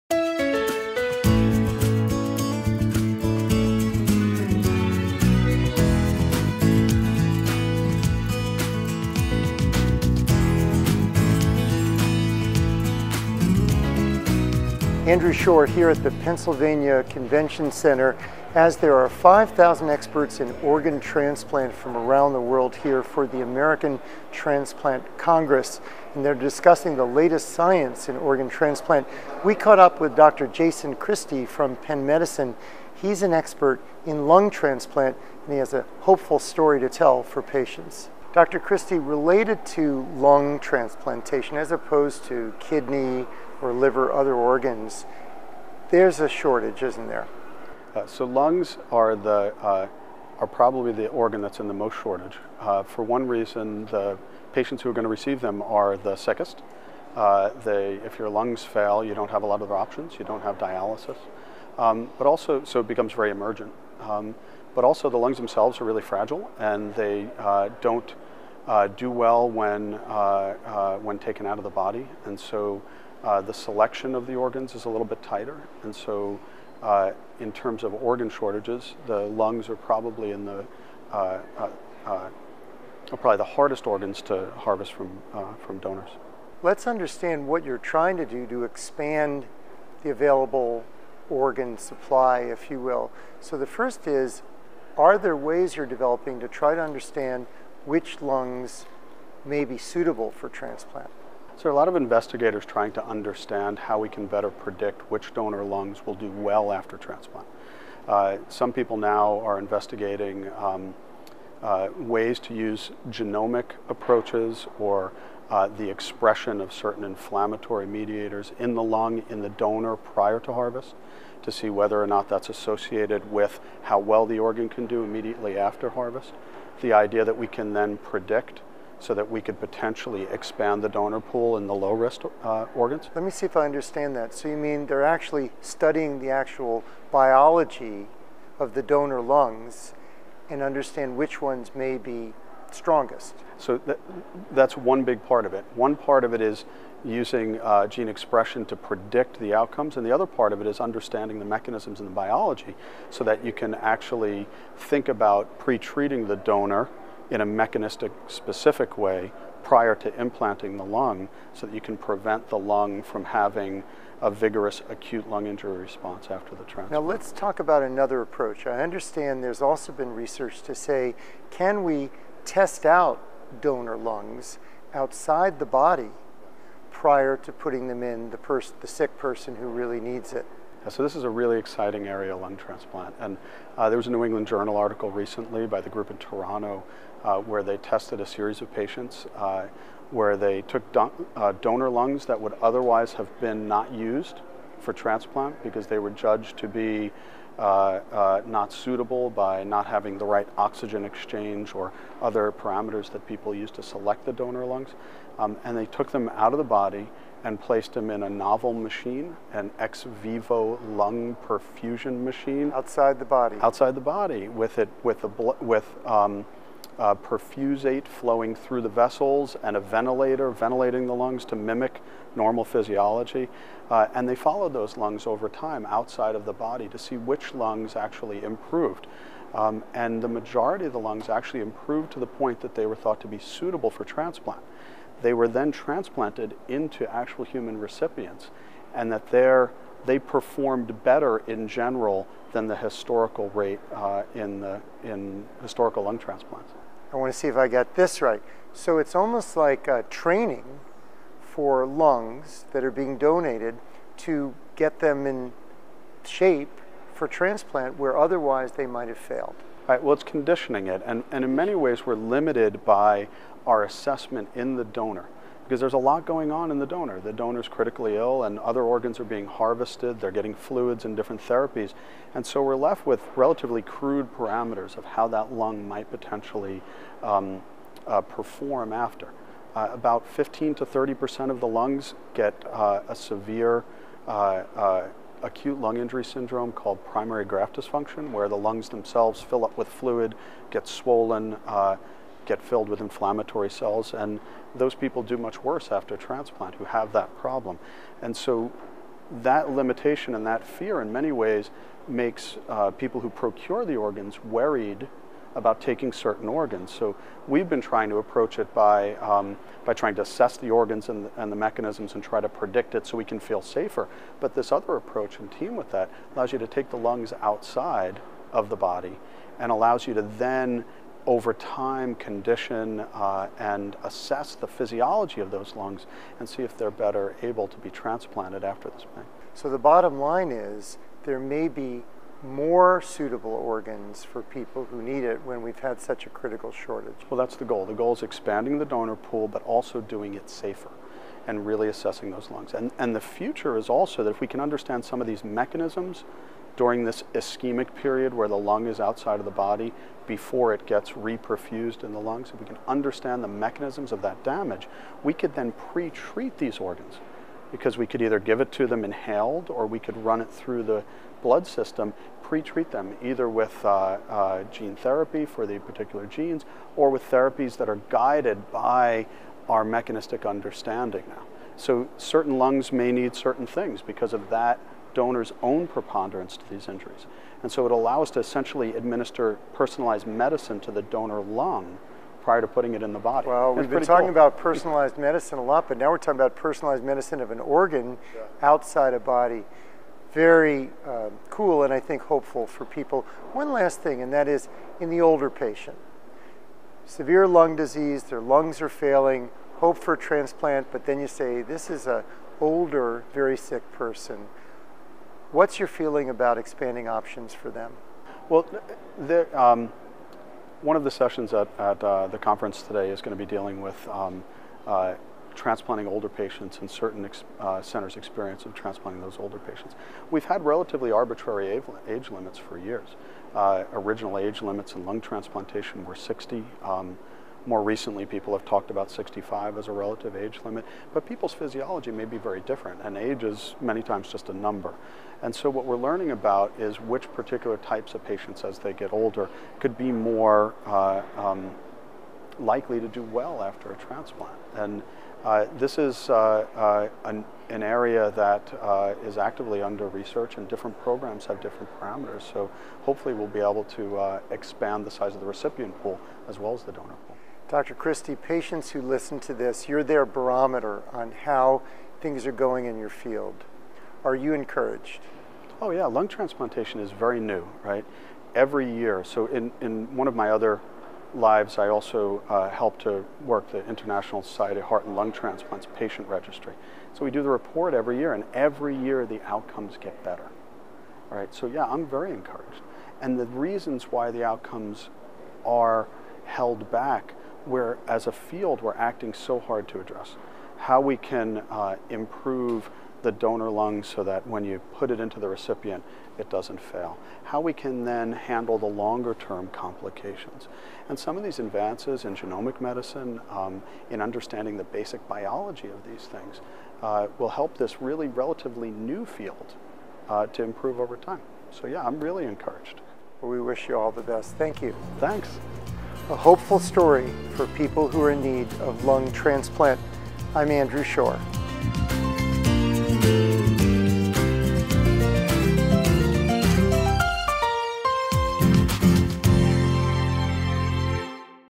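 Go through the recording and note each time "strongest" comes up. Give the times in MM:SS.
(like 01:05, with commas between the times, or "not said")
02:22.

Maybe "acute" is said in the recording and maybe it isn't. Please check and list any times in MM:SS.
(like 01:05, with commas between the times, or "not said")
02:44, 04:45.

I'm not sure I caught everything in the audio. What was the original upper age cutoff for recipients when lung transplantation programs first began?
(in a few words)
60.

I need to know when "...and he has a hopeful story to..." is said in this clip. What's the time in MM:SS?
00:35.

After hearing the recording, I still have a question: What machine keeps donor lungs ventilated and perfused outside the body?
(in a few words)
ex vivo lung perfusion machine.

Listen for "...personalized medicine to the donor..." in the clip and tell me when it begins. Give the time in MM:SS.
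06:19.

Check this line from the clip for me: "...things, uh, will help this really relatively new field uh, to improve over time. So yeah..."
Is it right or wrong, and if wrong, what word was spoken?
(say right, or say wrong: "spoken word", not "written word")
right.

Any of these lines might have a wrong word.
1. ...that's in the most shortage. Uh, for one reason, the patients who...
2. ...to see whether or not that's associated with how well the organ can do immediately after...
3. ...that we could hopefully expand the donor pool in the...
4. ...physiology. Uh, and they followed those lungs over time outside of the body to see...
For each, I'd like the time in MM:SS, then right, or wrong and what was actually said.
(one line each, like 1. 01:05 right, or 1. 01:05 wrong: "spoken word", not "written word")
1. 00:51 right
2. 02:01 right
3. 02:09 wrong: "potentially", not "hopefully"
4. 03:42 right.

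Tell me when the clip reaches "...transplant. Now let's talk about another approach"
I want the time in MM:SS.
02:46.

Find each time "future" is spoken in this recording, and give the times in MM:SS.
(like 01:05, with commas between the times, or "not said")
05:43.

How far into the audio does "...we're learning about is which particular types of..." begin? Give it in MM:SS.
07:15.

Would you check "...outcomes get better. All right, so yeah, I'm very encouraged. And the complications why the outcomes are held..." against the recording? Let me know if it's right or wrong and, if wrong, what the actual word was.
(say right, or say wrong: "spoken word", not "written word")
wrong: "reasons", not "complications".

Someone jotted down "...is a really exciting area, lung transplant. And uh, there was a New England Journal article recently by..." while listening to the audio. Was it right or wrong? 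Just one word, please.
right.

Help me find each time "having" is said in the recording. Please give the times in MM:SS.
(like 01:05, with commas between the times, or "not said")
02:43, 03:19.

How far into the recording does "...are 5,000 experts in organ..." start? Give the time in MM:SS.
00:18.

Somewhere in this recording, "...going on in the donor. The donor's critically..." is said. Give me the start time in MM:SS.
04:26.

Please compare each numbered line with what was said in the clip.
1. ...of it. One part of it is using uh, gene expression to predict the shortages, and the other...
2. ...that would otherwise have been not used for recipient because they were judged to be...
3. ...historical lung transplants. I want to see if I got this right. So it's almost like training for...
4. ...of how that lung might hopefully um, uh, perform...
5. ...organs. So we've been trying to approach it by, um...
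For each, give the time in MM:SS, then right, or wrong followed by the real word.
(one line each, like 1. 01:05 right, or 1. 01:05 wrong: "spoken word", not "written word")
1. 02:25 wrong: "outcomes", not "shortages"
2. 03:12 wrong: "transplant", not "recipient"
3. 04:05 right
4. 04:34 wrong: "potentially", not "hopefully"
5. 05:06 right.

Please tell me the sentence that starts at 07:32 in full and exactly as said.
So hopefully we'll be able to uh, expand the size of the recipient pool as well as the donor pool.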